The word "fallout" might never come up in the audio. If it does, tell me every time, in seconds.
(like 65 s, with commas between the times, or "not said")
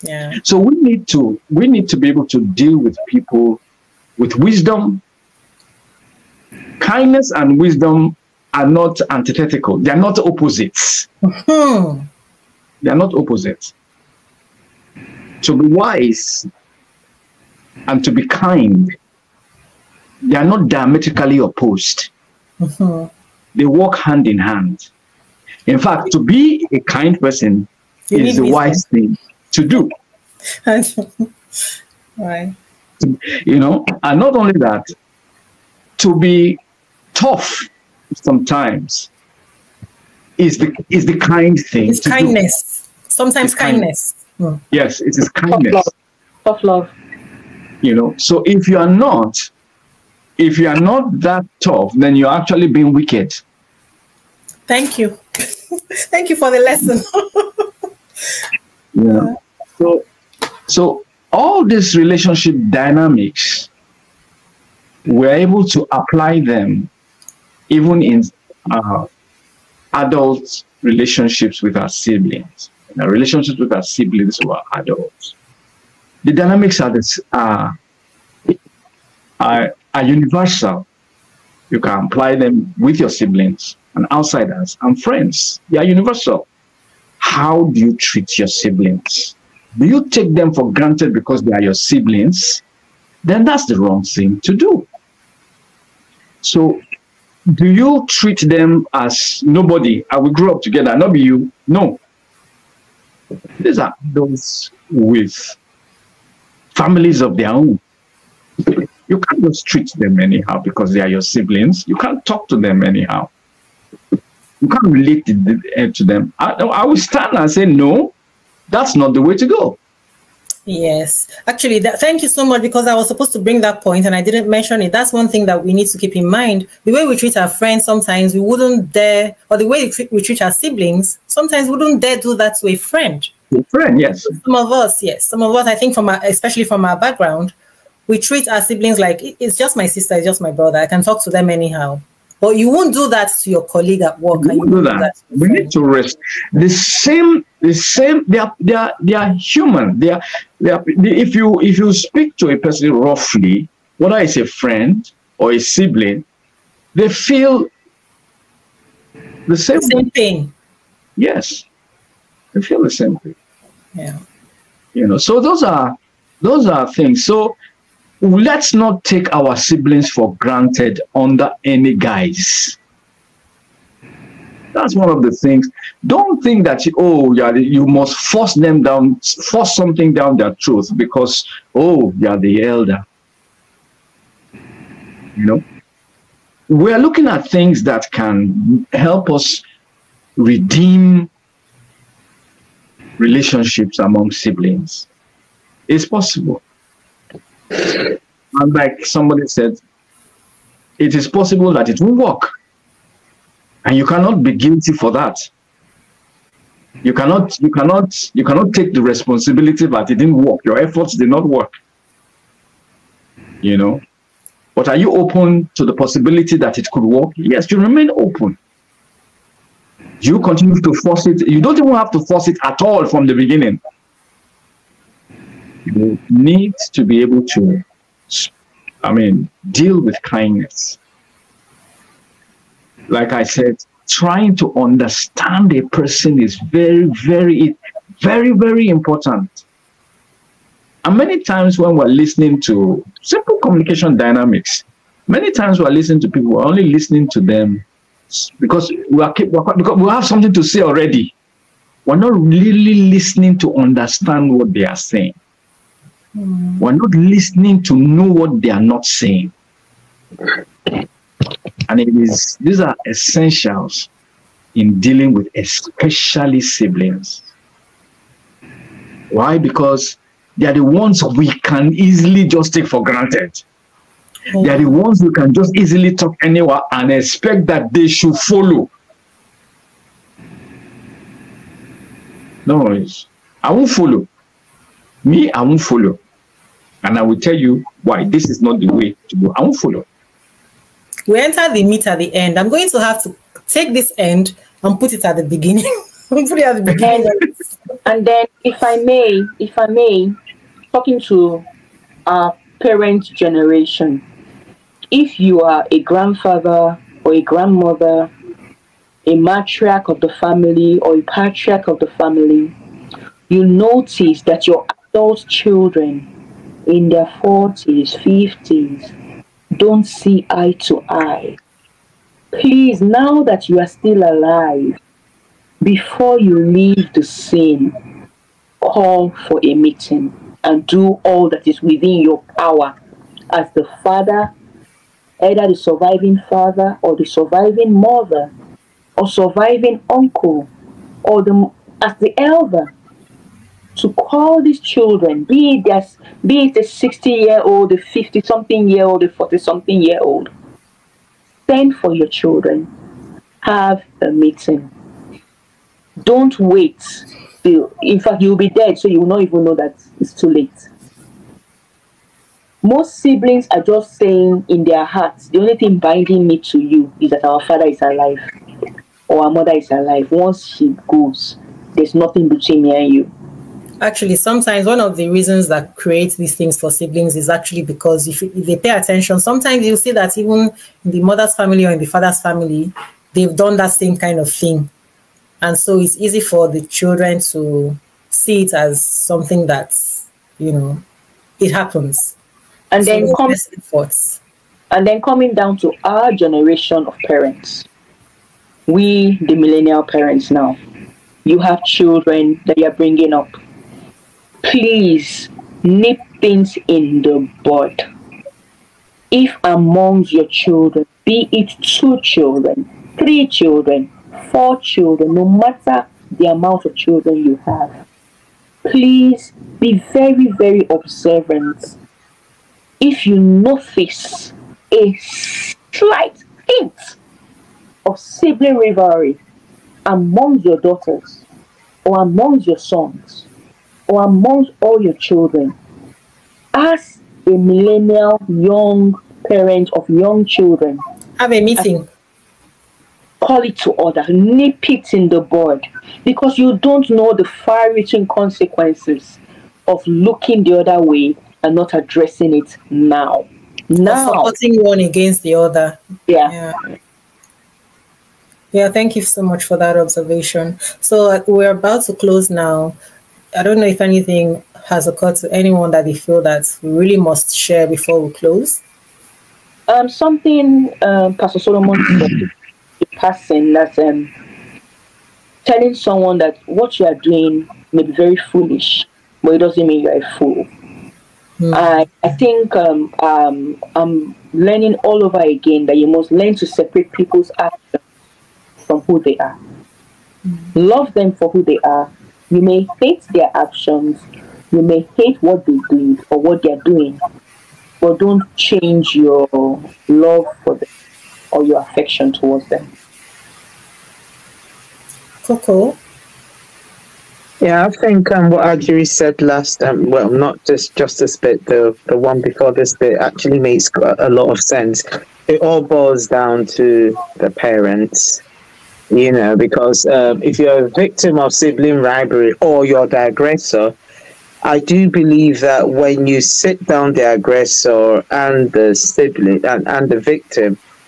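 not said.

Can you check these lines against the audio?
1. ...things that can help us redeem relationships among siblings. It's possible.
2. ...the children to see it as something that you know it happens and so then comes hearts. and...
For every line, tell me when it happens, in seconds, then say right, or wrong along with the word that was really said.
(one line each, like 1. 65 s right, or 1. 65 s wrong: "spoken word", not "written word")
1. 187 s right
2. 386 s wrong: "efforts", not "hearts".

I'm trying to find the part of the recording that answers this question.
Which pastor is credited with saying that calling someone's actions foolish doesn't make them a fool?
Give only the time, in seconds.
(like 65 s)
471 s.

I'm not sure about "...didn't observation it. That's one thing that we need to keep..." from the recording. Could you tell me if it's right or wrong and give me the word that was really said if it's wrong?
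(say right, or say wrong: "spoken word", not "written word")
wrong: "mention", not "observation".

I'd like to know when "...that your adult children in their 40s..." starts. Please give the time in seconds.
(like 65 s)
314 s.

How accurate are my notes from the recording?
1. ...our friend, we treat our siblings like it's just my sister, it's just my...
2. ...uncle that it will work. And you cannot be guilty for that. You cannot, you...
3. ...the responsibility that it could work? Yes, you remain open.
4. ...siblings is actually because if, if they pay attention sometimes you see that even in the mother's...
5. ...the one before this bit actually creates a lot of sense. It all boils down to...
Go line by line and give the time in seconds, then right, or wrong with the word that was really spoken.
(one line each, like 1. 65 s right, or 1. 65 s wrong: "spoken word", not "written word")
1. 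136 s wrong: "background", not "friend"
2. 201 s wrong: "possible", not "uncle"
3. 215 s wrong: "possibility", not "responsibility"
4. 376 s right
5. 512 s wrong: "makes", not "creates".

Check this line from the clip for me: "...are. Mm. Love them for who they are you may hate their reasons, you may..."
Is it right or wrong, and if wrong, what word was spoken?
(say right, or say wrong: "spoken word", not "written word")
wrong: "actions", not "reasons".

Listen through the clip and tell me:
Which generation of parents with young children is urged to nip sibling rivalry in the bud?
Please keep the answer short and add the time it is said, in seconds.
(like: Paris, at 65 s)
Millennial parents, at 399 s.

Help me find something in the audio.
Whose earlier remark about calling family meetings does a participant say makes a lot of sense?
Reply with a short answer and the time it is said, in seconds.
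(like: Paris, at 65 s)
Ajiri, at 508 s.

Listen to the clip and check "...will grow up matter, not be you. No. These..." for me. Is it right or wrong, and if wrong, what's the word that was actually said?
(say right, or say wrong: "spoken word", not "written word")
wrong: "together", not "matter".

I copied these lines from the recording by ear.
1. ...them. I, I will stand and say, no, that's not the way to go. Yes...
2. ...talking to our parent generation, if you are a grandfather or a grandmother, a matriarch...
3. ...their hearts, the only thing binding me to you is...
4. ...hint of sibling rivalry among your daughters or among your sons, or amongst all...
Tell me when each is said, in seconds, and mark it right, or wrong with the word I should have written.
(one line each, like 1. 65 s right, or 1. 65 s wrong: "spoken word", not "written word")
1. 115 s right
2. 300 s right
3. 364 s right
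4. 426 s right.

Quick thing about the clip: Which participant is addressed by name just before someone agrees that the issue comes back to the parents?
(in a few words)
Coco.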